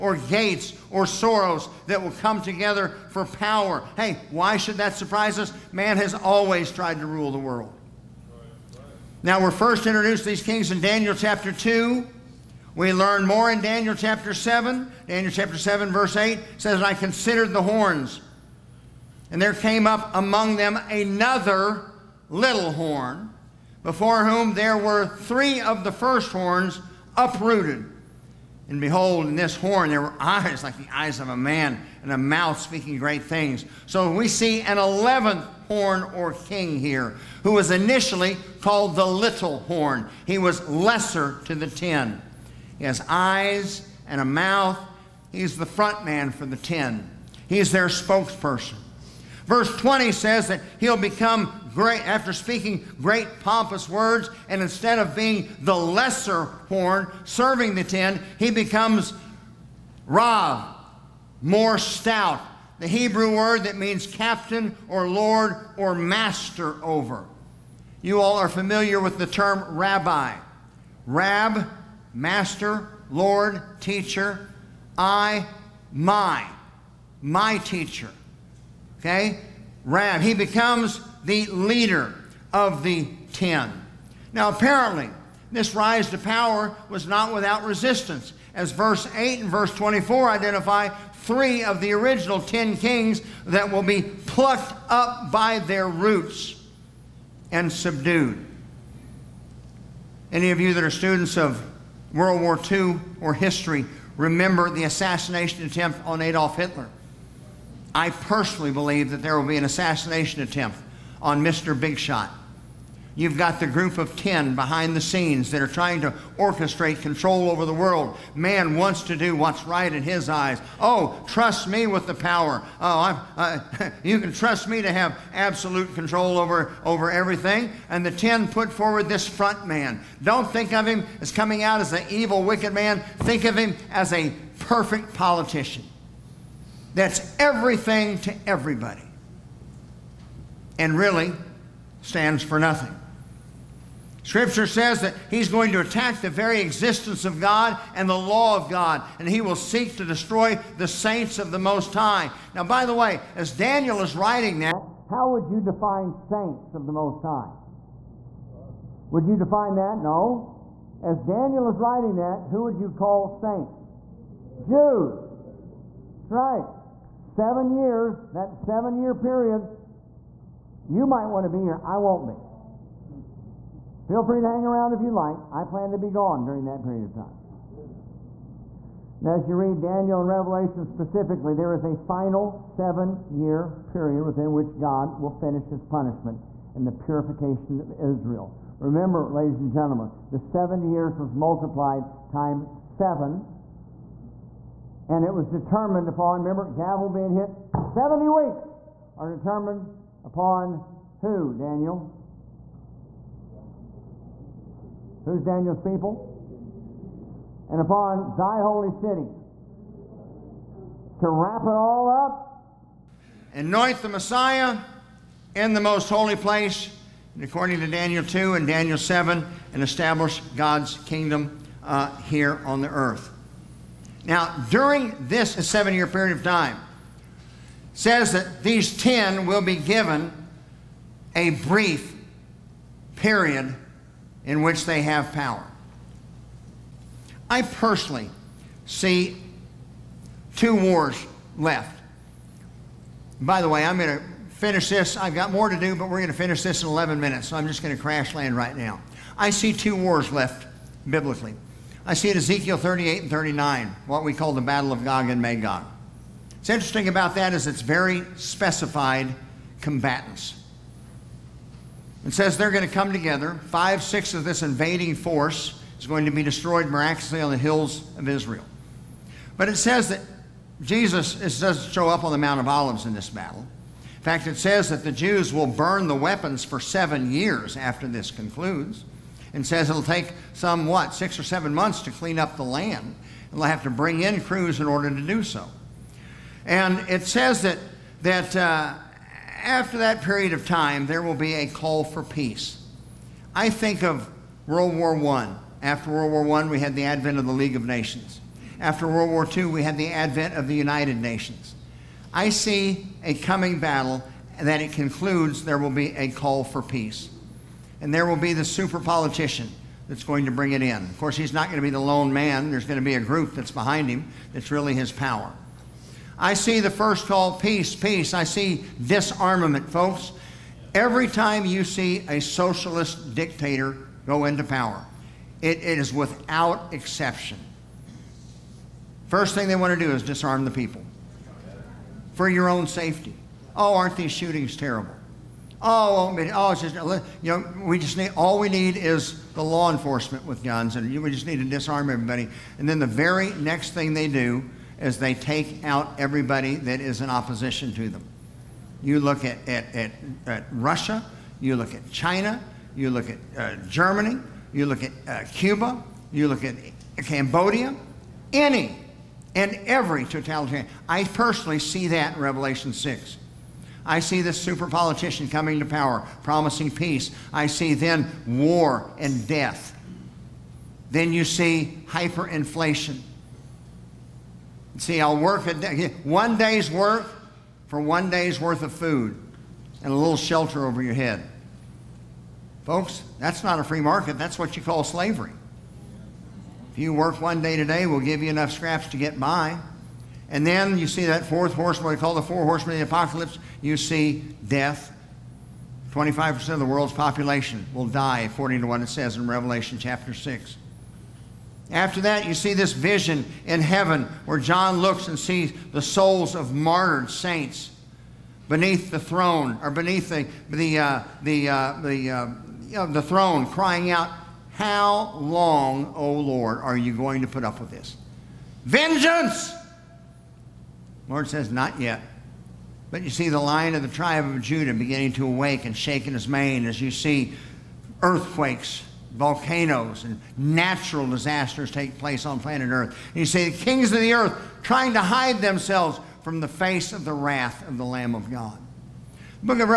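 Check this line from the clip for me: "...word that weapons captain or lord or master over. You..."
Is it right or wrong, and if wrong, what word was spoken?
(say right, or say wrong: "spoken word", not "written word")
wrong: "means", not "weapons".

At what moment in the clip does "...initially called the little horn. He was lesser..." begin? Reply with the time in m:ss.
0:37.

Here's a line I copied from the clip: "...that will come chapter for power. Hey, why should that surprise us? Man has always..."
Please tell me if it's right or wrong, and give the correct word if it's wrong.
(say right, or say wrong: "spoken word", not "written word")
wrong: "together", not "chapter".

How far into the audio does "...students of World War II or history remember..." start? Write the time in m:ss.
1:40.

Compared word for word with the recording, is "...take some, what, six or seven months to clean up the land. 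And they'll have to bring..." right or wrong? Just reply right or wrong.
right.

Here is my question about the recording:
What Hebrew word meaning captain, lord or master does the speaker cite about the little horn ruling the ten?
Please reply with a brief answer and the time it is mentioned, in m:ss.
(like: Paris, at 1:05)
Rav, at 1:00.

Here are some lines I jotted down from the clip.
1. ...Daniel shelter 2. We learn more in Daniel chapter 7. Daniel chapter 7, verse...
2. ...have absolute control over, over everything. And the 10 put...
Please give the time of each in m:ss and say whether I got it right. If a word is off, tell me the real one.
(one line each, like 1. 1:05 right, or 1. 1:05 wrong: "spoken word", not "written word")
1. 0:10 wrong: "chapter", not "shelter"
2. 2:04 right.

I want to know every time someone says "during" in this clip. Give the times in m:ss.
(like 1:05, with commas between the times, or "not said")
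2:56, 3:44.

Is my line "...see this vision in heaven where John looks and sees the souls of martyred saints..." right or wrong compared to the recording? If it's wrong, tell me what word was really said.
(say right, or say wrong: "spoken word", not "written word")
right.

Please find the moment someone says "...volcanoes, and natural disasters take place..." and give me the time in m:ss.
7:09.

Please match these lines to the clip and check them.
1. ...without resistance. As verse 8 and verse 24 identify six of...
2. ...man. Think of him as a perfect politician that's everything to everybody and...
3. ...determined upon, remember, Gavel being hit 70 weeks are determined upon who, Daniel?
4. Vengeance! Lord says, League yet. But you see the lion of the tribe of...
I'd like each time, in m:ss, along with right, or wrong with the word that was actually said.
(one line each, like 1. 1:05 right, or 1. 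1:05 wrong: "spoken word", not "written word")
1. 1:27 wrong: "three", not "six"
2. 2:12 right
3. 3:15 right
4. 6:58 wrong: "Not", not "League".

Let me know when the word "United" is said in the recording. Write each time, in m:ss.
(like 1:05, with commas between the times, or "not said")
5:00.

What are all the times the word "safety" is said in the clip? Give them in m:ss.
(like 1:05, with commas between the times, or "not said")
5:32.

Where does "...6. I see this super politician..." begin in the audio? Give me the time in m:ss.
6:02.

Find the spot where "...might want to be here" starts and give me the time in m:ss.
2:51.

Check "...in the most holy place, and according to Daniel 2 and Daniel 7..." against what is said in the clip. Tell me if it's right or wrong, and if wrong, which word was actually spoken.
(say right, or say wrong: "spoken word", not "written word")
right.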